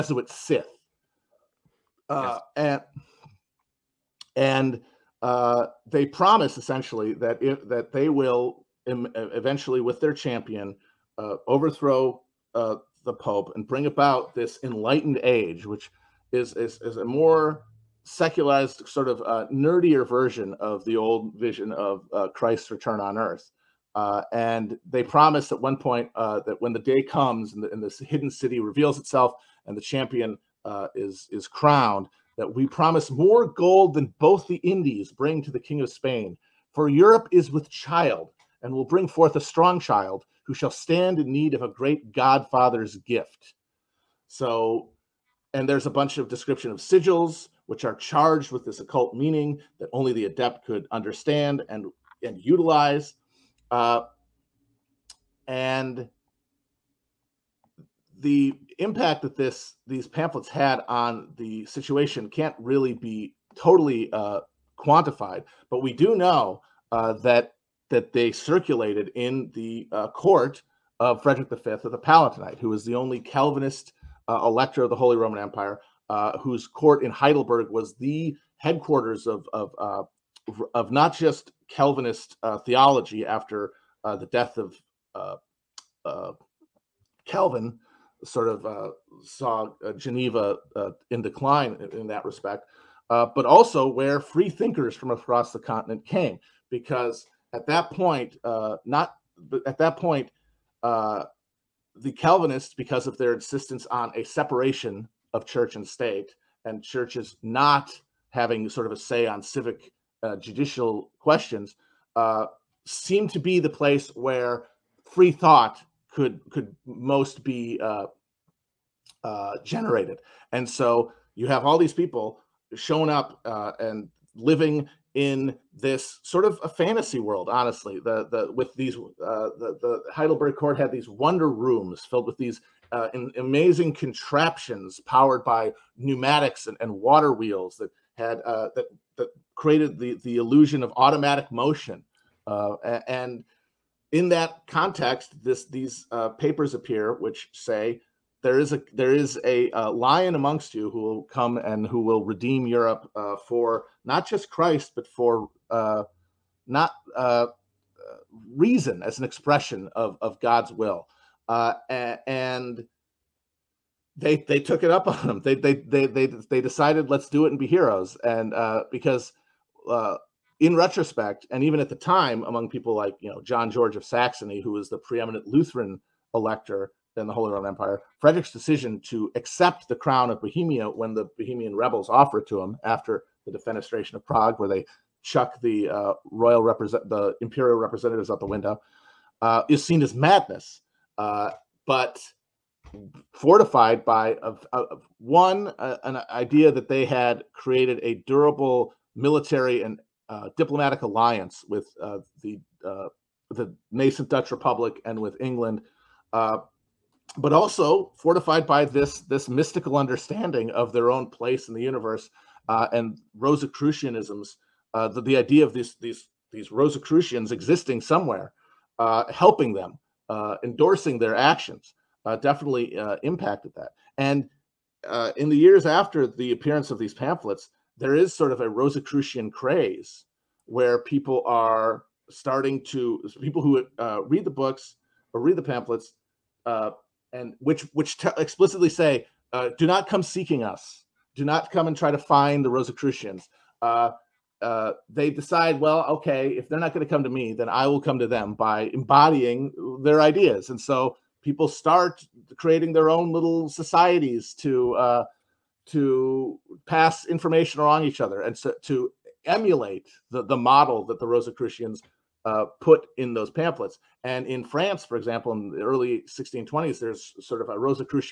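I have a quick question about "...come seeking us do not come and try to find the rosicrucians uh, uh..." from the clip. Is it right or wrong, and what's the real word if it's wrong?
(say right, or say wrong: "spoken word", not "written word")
right.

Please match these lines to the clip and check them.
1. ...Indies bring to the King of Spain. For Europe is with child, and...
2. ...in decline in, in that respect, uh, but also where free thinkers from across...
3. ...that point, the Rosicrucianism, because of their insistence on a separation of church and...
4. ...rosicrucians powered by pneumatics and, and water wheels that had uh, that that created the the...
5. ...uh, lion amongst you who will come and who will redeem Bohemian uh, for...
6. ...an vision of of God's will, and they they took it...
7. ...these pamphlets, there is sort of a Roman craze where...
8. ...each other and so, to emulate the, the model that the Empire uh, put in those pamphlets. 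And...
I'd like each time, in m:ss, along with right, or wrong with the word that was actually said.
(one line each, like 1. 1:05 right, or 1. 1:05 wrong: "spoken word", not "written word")
1. 0:34 right
2. 1:31 right
3. 1:39 wrong: "Calvinists", not "Rosicrucianism"
4. 2:13 wrong: "contraptions", not "rosicrucians"
5. 2:29 wrong: "Europe", not "Bohemian"
6. 2:39 wrong: "expression", not "vision"
7. 3:46 wrong: "Rosicrucian", not "Roman"
8. 4:18 wrong: "Rosicrucians", not "Empire".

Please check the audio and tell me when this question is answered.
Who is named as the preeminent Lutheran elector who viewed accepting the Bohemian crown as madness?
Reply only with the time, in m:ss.
2:53.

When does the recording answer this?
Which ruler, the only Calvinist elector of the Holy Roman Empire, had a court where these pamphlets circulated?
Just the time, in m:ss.
1:11.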